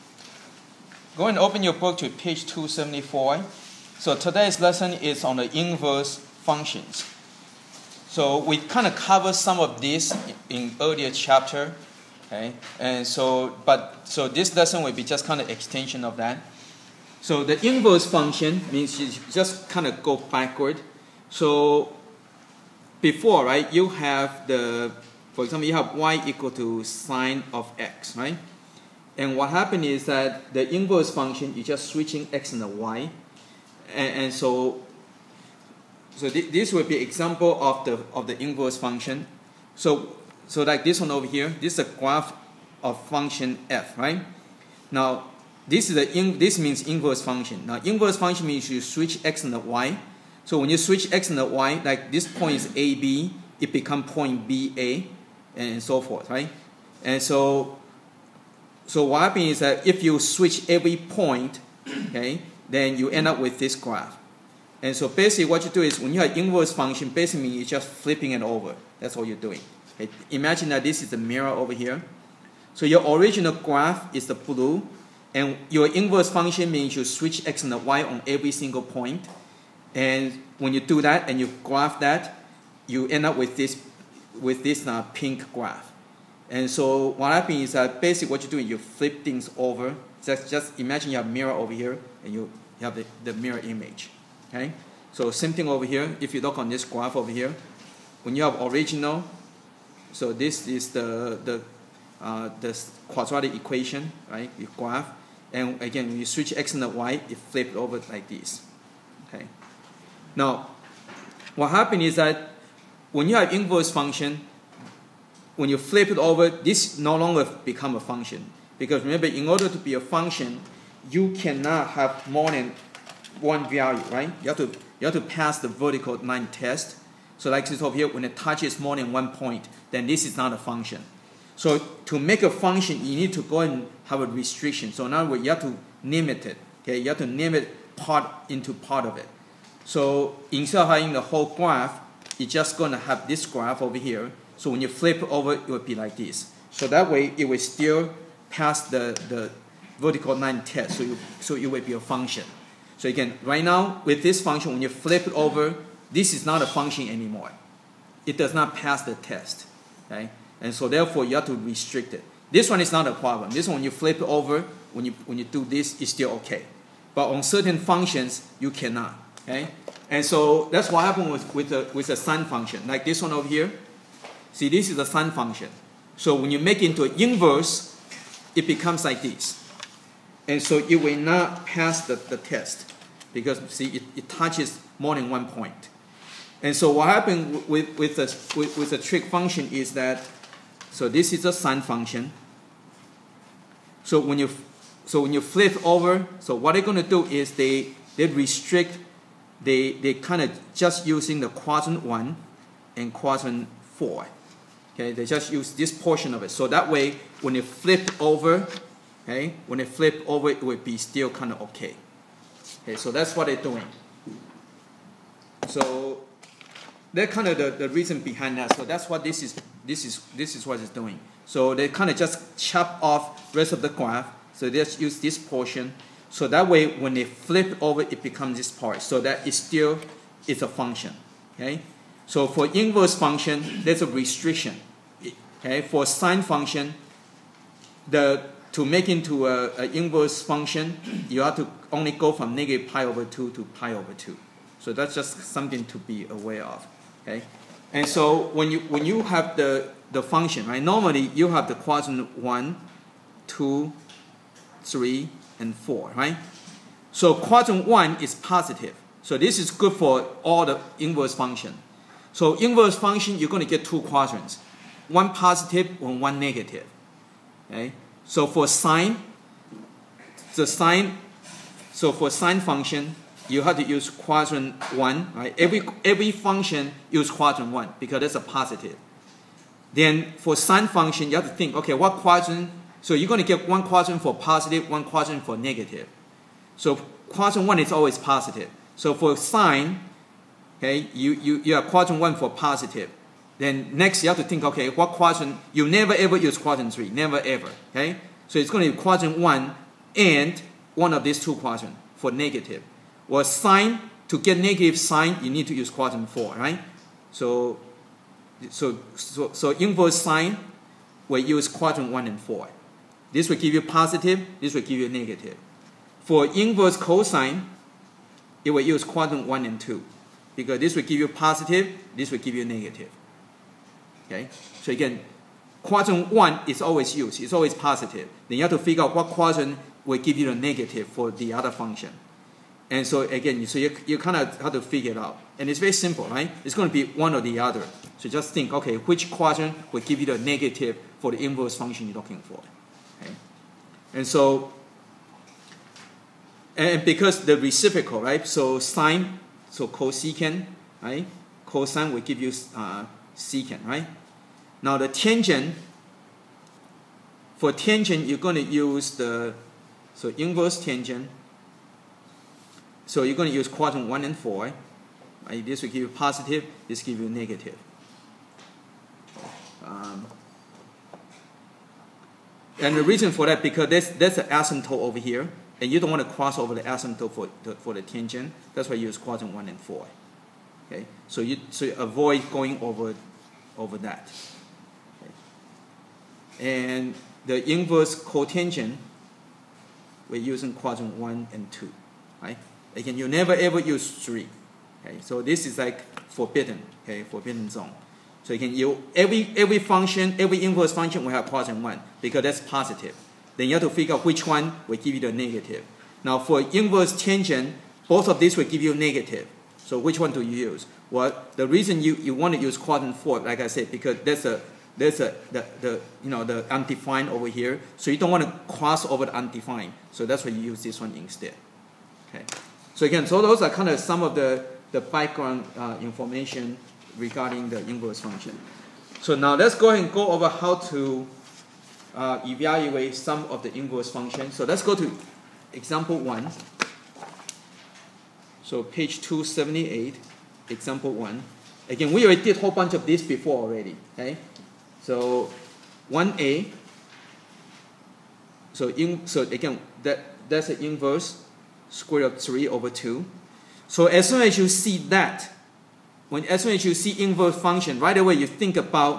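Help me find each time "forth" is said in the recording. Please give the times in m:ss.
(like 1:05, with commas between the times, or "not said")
0:56.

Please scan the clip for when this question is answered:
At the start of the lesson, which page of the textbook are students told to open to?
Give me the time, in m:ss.
0:02.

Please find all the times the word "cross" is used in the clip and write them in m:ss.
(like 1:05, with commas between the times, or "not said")
6:16, 6:58.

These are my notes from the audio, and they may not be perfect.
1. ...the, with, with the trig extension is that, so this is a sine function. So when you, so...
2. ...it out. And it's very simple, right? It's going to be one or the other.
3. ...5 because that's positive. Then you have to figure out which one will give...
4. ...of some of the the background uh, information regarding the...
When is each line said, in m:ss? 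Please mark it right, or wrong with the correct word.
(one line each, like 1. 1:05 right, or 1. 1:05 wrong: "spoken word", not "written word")
1. 3:08 wrong: "function", not "extension"
2. 5:35 right
3. 6:41 wrong: "1", not "5"
4. 7:03 right.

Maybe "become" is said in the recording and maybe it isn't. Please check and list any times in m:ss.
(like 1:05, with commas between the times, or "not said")
0:53, 1:57, 2:58, 3:48.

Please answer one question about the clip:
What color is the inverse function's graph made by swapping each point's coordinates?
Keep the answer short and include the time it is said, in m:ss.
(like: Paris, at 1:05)
pink, at 1:25.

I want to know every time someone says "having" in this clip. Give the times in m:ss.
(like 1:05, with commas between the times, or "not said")
2:20.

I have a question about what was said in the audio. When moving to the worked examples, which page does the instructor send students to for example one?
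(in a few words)
278.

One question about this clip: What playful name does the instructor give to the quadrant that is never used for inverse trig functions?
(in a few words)
forbidden zone.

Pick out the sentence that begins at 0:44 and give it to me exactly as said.
Now, this is the in, this means inverse function.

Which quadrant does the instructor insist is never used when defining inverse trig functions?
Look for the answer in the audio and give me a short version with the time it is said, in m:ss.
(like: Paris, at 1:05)
quadrant three, at 4:56.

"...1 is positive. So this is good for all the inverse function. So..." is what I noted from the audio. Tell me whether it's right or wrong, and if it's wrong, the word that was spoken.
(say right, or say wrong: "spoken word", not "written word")
right.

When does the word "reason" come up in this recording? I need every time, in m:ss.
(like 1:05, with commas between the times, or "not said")
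3:37, 6:13, 6:51.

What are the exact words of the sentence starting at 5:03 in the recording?
Well, sine, to get negative sine, you need to use quadrant four, right?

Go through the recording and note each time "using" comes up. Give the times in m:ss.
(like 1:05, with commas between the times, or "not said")
3:21, 6:30.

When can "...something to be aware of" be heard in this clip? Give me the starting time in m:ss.
4:05.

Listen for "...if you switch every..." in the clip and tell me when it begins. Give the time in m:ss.
0:59.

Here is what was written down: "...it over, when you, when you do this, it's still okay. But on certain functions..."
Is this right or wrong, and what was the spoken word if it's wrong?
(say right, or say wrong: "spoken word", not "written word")
right.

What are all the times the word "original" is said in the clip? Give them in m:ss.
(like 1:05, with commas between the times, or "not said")
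1:13, 1:38.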